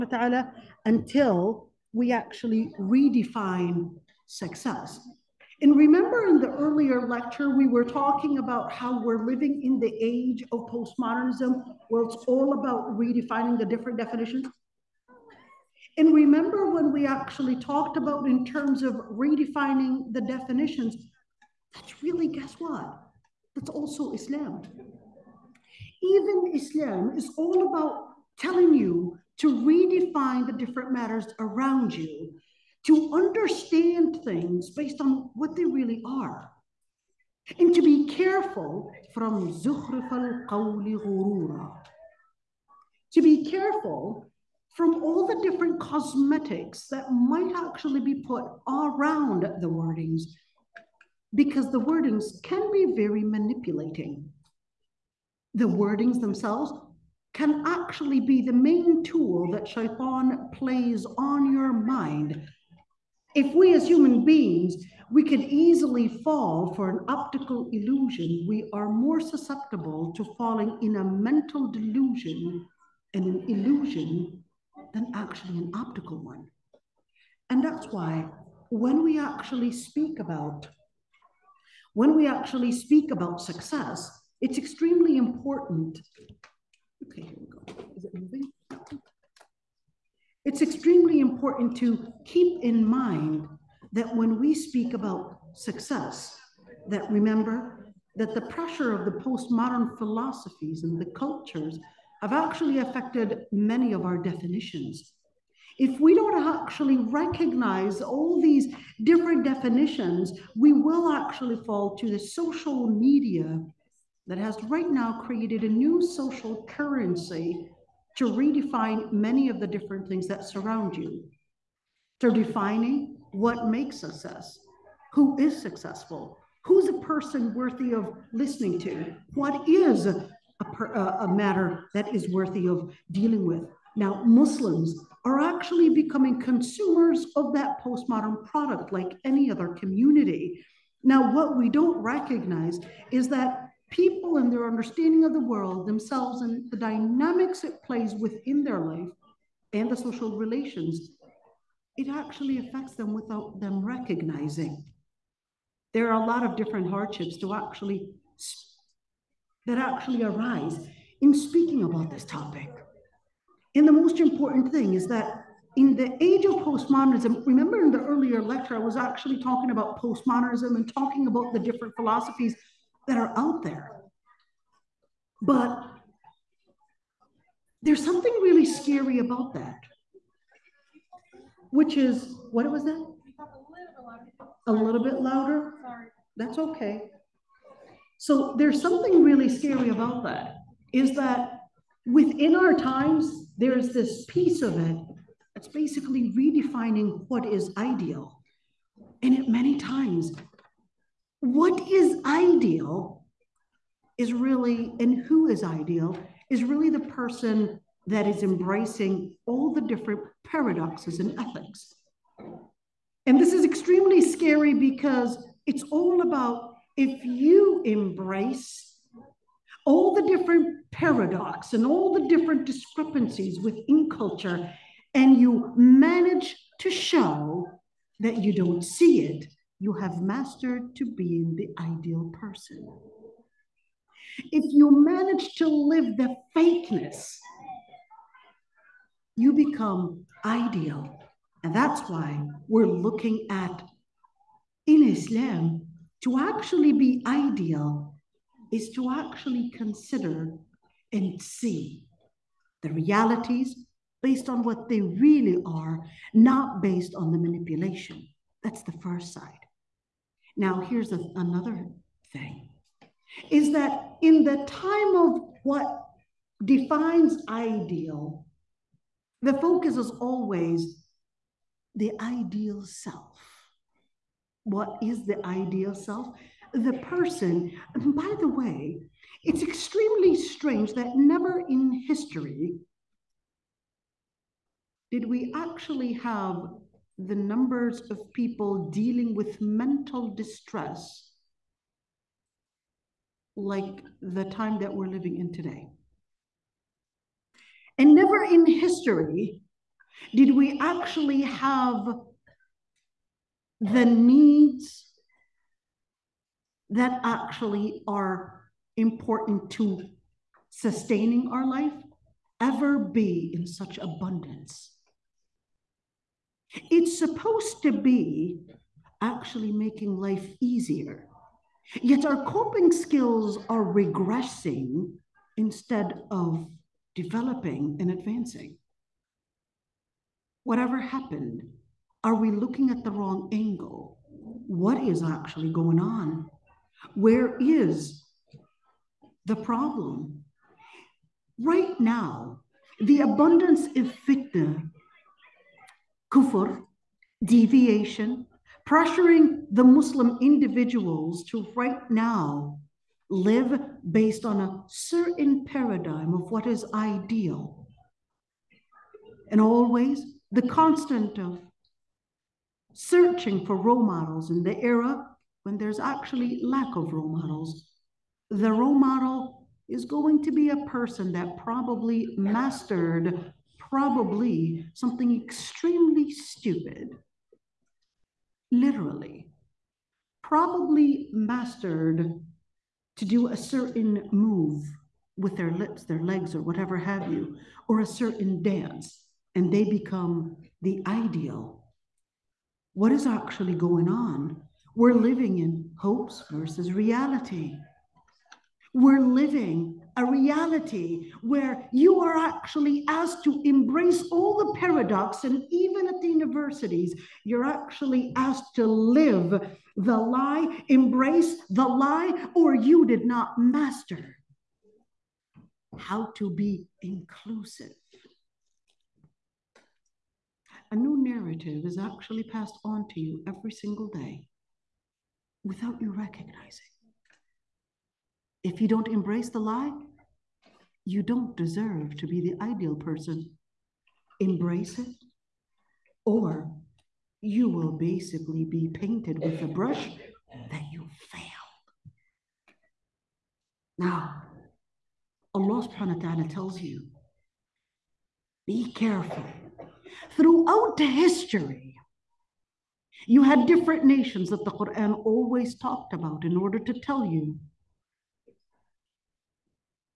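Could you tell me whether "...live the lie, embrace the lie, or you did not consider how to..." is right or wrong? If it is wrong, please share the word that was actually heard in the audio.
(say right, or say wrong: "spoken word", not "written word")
wrong: "master", not "consider".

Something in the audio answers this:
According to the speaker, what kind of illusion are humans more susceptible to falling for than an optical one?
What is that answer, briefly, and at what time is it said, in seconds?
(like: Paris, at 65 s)
mental delusion, at 71 s.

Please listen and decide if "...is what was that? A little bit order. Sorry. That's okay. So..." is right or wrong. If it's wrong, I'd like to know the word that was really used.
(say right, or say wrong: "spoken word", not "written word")
wrong: "louder", not "order".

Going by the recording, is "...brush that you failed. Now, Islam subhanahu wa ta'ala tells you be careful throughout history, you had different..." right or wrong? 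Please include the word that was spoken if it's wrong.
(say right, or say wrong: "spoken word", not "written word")
wrong: "Allah", not "Islam".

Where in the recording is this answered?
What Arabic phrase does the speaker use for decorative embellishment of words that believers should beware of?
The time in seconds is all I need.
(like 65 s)
39 s.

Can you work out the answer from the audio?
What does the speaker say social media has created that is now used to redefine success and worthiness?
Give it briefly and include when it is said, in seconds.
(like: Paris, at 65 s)
a new social currency, at 115 s.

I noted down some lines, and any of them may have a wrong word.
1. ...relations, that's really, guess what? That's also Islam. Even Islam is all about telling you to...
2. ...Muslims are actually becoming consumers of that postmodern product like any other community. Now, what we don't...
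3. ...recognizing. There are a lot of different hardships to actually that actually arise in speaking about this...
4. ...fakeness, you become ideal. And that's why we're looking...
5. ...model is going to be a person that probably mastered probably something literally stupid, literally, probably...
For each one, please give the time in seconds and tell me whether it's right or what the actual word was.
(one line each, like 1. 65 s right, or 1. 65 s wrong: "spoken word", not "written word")
1. 20 s wrong: "definitions", not "relations"
2. 134 s right
3. 153 s right
4. 236 s right
5. 368 s wrong: "extremely", not "literally".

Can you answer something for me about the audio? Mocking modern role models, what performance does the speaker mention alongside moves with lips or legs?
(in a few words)
a certain dance.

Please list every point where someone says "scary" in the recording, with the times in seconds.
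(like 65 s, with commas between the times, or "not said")
178 s, 189 s, 214 s.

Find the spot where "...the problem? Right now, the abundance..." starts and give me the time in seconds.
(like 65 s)
339 s.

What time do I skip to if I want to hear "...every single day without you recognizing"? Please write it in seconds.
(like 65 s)
423 s.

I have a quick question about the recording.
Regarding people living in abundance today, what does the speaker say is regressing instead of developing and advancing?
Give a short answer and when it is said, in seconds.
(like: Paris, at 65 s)
coping skills, at 322 s.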